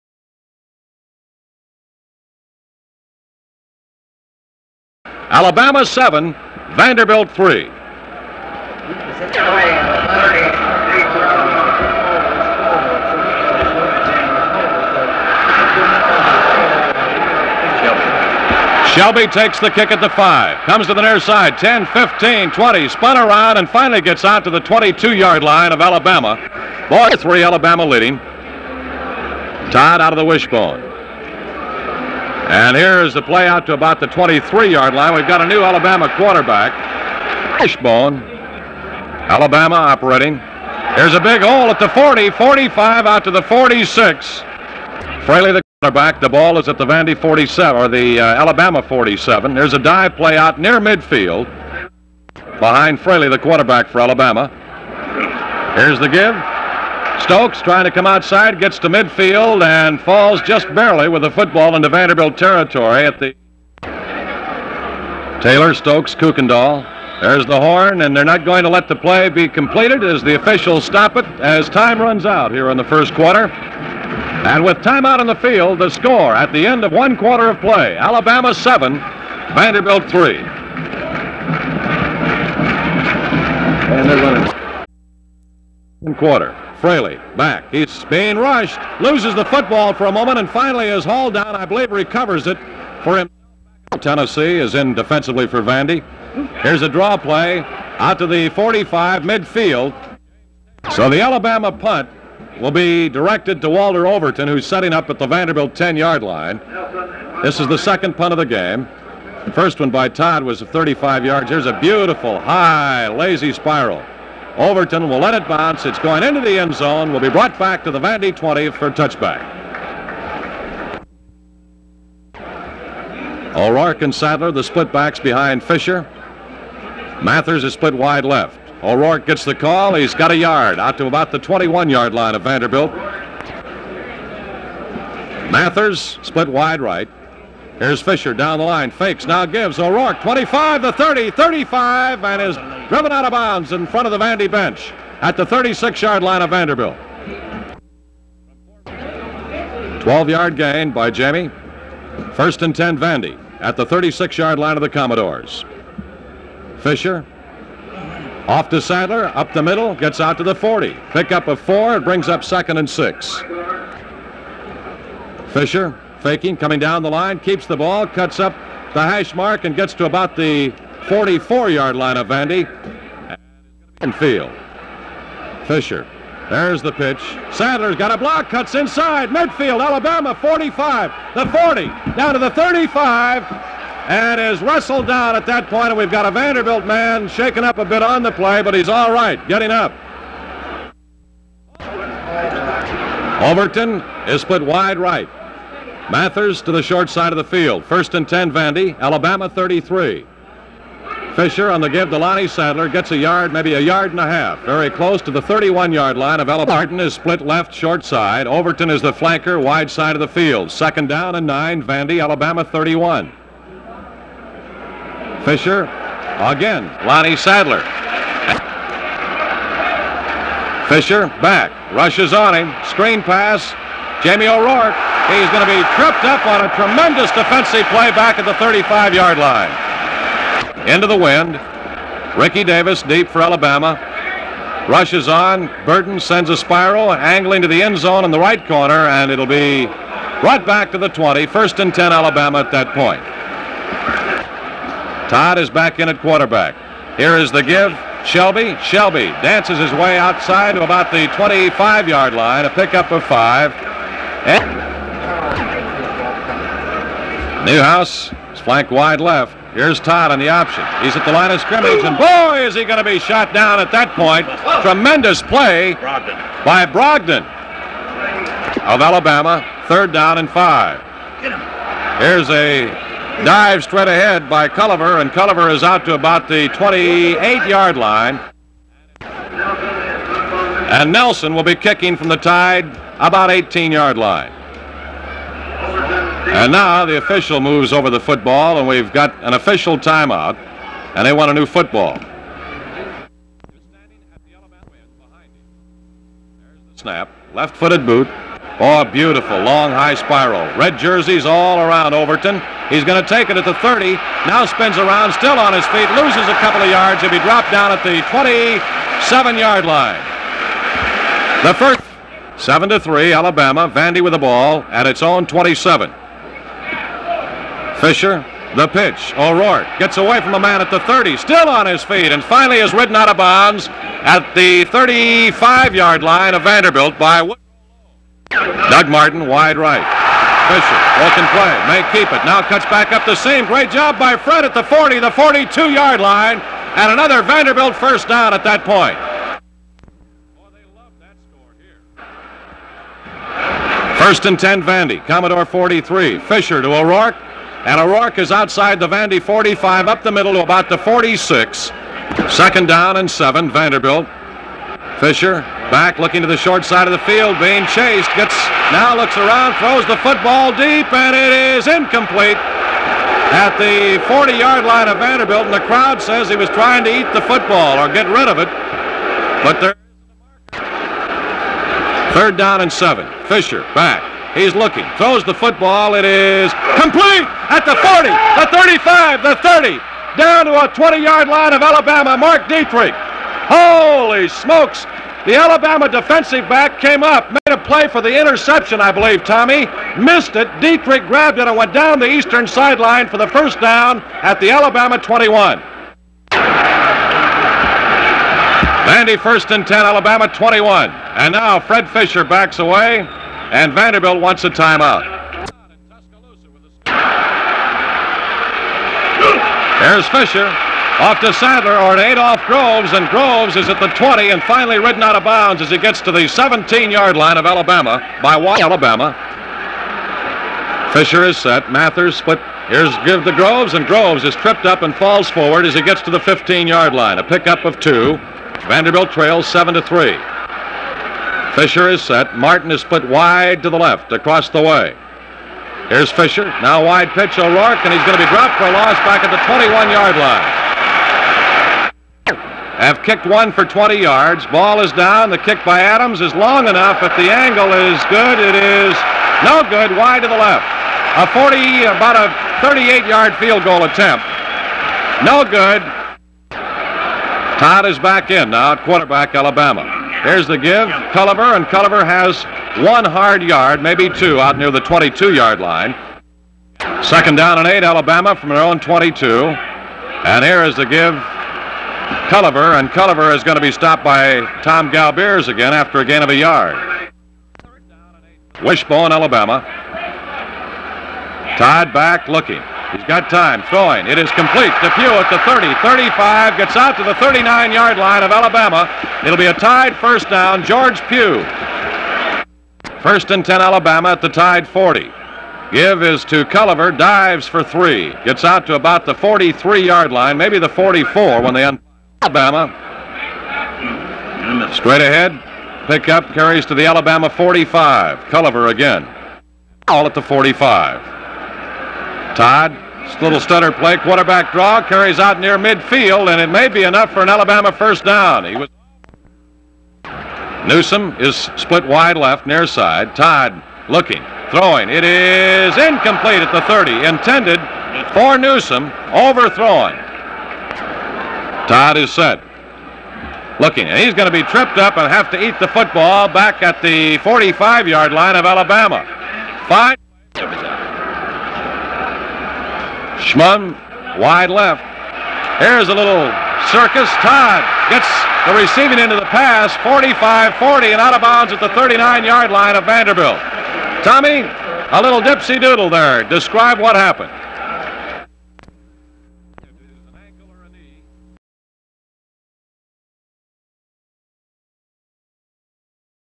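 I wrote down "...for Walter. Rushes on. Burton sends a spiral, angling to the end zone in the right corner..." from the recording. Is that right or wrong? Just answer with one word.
wrong.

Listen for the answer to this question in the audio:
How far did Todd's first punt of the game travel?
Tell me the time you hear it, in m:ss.
1:50.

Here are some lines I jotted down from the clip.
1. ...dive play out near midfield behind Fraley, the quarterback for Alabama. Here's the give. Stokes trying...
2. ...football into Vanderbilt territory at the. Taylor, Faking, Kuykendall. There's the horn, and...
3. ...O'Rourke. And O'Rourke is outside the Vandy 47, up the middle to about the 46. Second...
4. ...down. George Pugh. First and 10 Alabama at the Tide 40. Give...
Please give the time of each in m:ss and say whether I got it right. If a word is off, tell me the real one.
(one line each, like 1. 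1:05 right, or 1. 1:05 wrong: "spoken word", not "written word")
1. 0:49 right
2. 1:01 wrong: "Stokes", not "Faking"
3. 5:46 wrong: "45", not "47"
4. 8:10 right.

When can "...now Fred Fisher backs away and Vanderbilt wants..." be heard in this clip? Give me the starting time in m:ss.
6:41.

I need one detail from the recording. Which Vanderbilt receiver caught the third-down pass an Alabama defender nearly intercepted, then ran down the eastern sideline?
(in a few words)
Mark Dietrich.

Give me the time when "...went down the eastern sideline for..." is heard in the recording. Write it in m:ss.
6:31.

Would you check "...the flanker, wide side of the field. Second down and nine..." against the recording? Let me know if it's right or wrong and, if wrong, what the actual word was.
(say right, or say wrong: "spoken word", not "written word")
right.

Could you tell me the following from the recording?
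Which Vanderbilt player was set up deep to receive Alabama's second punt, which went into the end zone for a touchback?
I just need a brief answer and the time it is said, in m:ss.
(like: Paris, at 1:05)
Walter Overton, at 1:43.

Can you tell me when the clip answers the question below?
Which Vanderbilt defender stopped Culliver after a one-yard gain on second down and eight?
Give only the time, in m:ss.
7:54.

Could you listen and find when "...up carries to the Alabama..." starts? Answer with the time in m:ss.
8:26.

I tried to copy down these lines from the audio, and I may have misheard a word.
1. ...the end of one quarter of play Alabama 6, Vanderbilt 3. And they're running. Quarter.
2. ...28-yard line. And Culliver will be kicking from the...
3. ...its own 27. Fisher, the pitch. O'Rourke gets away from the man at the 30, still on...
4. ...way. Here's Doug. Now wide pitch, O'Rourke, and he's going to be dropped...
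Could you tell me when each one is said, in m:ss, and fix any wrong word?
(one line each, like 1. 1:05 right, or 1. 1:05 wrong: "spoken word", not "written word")
1. 1:16 wrong: "7", not "6"
2. 4:36 wrong: "Nelson", not "Culliver"
3. 5:15 right
4. 7:14 wrong: "Fisher", not "Doug".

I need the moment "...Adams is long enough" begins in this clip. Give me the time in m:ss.
7:26.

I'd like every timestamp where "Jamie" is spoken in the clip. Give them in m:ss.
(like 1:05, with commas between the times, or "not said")
2:31, 3:44.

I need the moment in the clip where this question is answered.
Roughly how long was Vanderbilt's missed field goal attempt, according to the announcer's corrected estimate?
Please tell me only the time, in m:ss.
7:32.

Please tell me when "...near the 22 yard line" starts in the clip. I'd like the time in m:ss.
7:44.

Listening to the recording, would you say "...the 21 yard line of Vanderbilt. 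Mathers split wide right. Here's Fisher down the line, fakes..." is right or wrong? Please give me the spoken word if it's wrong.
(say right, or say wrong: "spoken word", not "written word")
right.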